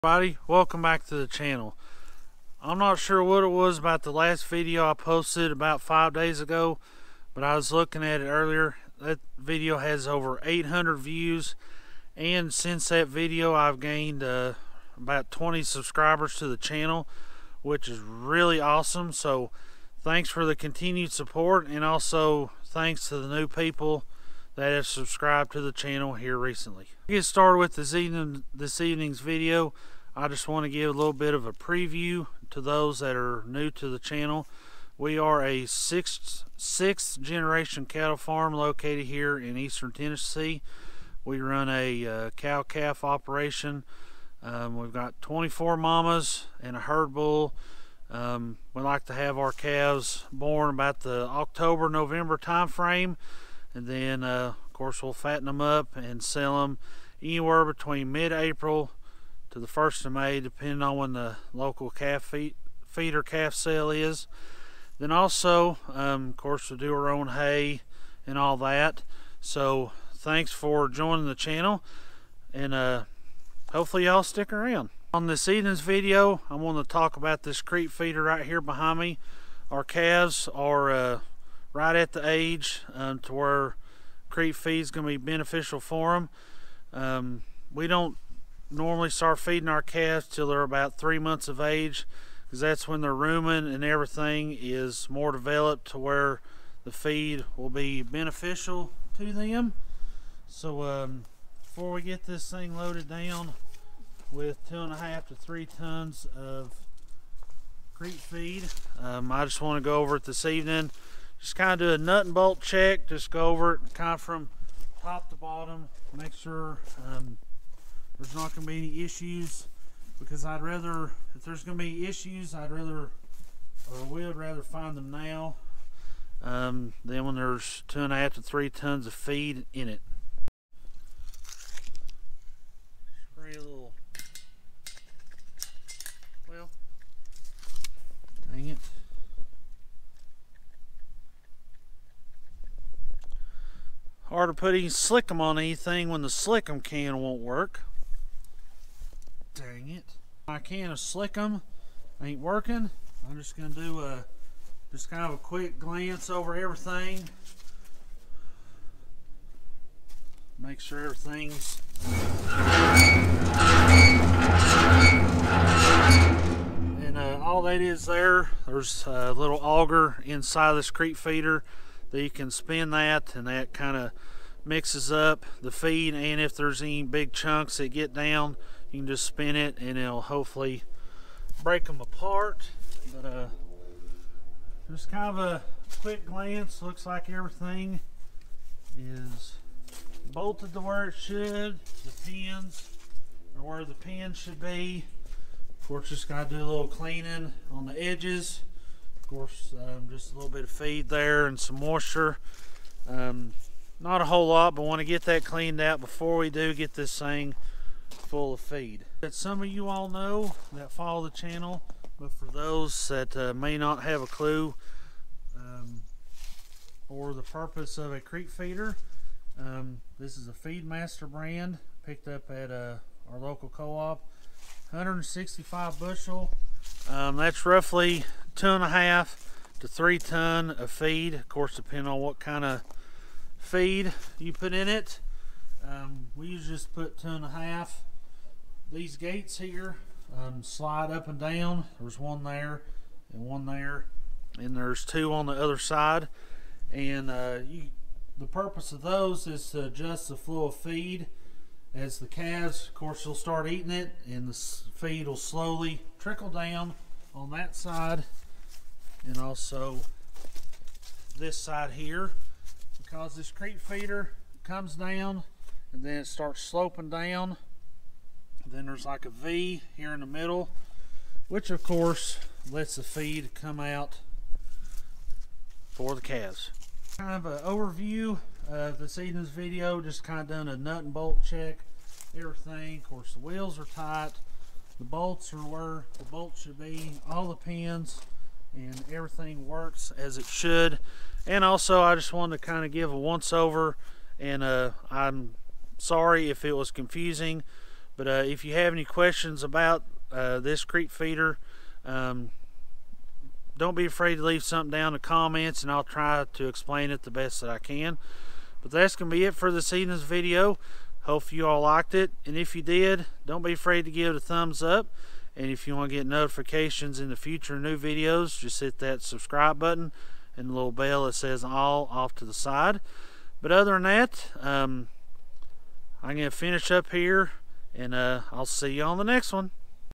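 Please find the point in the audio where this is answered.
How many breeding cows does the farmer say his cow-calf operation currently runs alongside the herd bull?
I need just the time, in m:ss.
0:45.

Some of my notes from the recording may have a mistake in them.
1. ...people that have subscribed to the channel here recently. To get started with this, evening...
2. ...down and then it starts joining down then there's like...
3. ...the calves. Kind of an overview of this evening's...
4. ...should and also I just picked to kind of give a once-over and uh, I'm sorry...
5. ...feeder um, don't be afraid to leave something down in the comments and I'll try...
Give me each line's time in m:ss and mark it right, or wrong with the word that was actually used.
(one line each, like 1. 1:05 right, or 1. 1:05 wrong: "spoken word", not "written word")
1. 0:23 right
2. 4:24 wrong: "sloping", not "joining"
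3. 4:36 right
4. 4:50 wrong: "wanted", not "picked"
5. 5:01 right.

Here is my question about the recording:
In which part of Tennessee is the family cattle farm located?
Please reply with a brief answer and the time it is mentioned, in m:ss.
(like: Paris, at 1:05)
eastern Tennessee, at 0:39.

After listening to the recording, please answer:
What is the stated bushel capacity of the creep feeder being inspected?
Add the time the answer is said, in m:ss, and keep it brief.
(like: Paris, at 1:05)
165 bushels, at 3:44.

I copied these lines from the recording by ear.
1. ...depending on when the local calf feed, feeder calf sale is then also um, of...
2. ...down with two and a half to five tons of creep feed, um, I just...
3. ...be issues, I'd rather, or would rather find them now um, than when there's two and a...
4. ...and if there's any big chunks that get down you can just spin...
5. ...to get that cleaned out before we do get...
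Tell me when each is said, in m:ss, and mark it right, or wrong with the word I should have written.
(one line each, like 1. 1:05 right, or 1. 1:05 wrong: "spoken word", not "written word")
1. 1:00 right
2. 1:43 wrong: "three", not "five"
3. 2:01 right
4. 2:56 right
5. 3:24 right.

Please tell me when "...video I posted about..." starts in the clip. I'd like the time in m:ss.
0:04.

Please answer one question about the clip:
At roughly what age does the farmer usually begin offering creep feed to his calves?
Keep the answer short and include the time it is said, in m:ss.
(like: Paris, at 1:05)
3 months, at 1:30.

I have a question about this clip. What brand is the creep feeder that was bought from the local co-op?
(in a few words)
Feedmaster.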